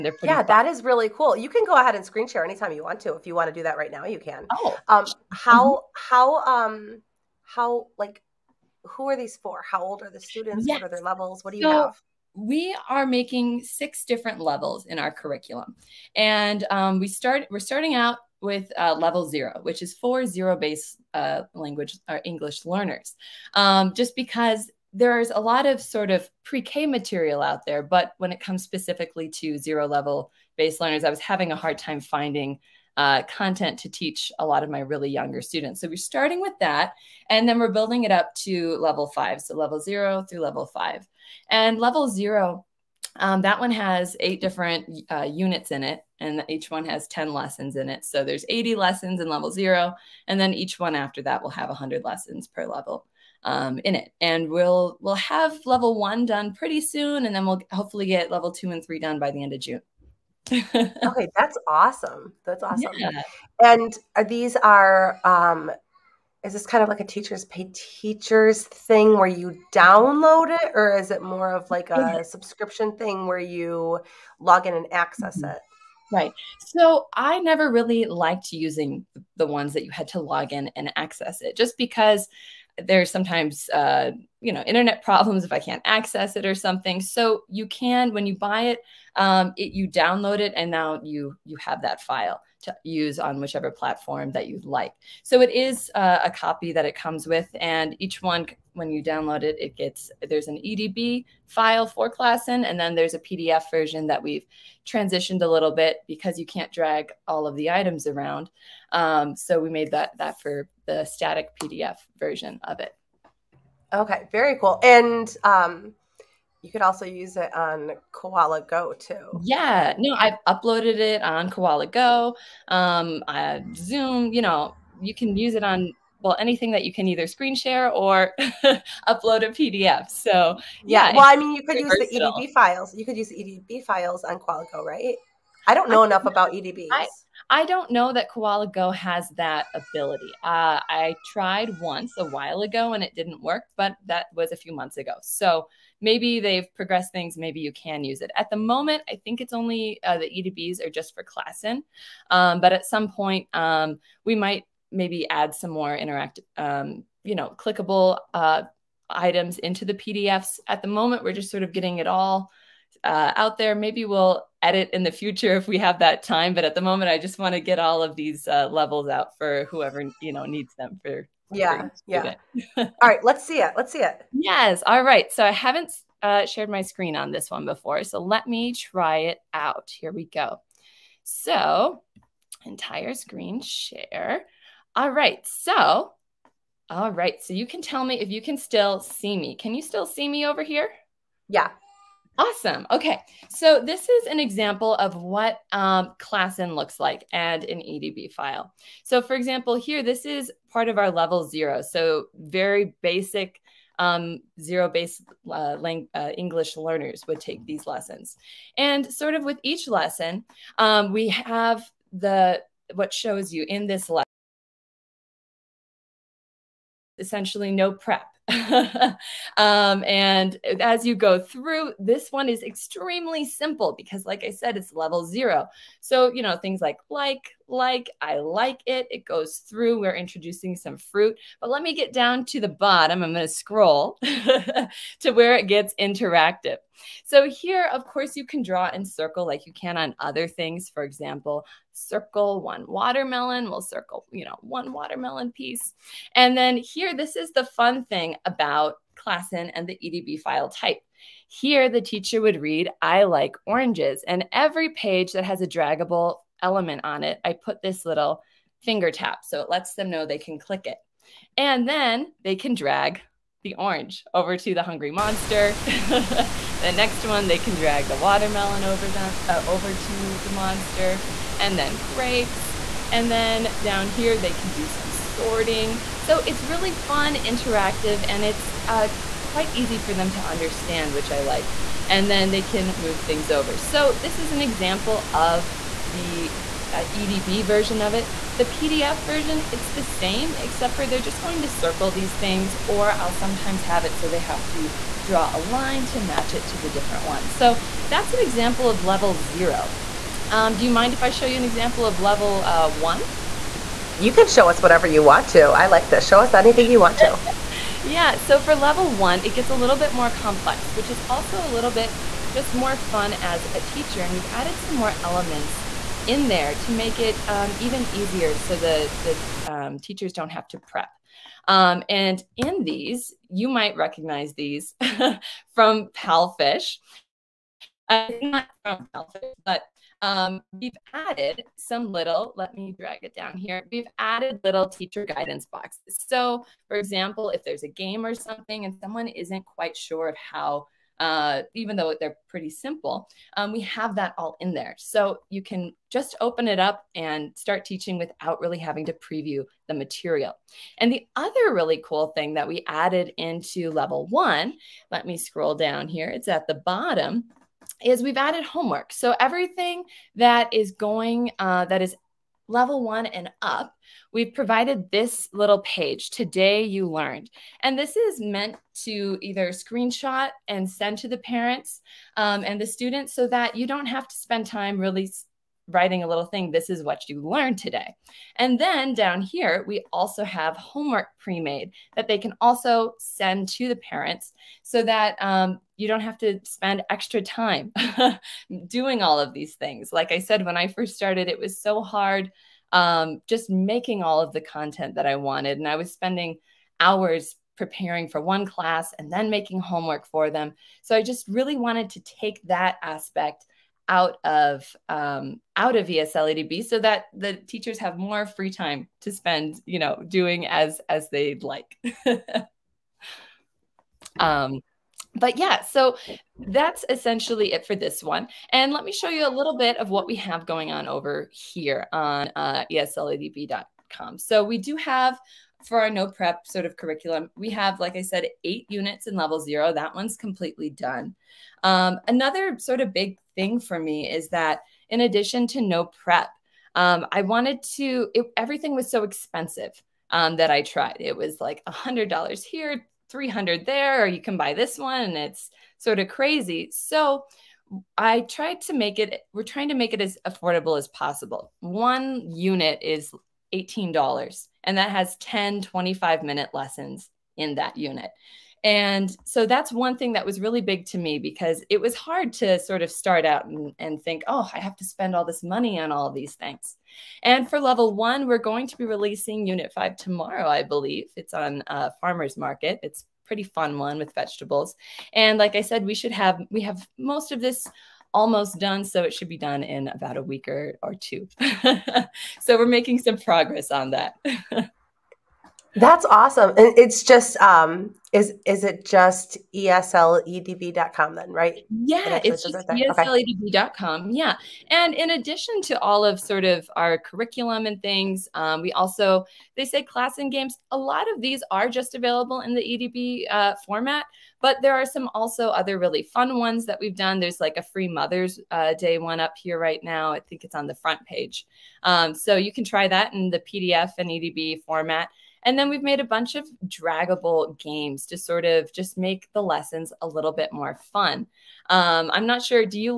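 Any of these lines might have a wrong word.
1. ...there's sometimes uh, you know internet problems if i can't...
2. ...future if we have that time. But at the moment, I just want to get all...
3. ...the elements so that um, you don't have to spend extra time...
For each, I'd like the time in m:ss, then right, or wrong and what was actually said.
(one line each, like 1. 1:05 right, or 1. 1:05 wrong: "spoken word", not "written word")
1. 1:22 right
2. 2:45 right
3. 6:23 wrong: "parents", not "elements".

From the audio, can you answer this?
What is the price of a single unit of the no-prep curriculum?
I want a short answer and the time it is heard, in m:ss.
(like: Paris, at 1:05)
$18, at 7:33.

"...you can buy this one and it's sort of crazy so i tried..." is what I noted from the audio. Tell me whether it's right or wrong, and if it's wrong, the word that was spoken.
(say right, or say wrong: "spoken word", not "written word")
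right.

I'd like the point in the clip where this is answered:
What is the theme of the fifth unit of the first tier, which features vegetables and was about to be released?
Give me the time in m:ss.
7:52.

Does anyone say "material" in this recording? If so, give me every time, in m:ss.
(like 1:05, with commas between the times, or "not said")
0:26, 5:49.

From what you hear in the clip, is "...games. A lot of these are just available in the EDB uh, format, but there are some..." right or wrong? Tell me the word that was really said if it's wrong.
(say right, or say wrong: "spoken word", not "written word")
right.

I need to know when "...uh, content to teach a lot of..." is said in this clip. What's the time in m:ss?
0:32.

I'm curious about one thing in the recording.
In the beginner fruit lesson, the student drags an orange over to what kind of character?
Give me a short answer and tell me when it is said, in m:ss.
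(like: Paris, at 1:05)
hungry monster, at 4:24.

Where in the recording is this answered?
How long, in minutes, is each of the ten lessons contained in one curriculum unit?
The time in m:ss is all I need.
7:35.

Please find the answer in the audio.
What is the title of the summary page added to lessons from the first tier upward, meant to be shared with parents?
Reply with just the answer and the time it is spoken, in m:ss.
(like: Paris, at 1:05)
Today You Learned, at 6:06.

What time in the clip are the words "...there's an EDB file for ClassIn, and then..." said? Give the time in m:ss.
1:40.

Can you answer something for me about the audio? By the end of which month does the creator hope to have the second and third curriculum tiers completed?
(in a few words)
June.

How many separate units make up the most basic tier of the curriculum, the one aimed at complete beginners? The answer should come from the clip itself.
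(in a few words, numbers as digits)
8.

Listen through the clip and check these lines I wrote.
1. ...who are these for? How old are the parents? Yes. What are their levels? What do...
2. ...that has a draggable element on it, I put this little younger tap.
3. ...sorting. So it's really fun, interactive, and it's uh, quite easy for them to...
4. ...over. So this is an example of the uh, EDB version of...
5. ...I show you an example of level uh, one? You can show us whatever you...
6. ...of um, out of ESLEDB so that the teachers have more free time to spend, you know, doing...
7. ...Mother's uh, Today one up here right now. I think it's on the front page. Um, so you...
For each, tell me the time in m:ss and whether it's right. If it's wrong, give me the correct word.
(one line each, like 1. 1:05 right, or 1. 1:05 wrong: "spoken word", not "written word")
1. 0:08 wrong: "students", not "parents"
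2. 4:15 wrong: "finger", not "younger"
3. 4:35 right
4. 4:43 right
5. 5:01 right
6. 6:44 right
7. 8:28 wrong: "Day", not "Today".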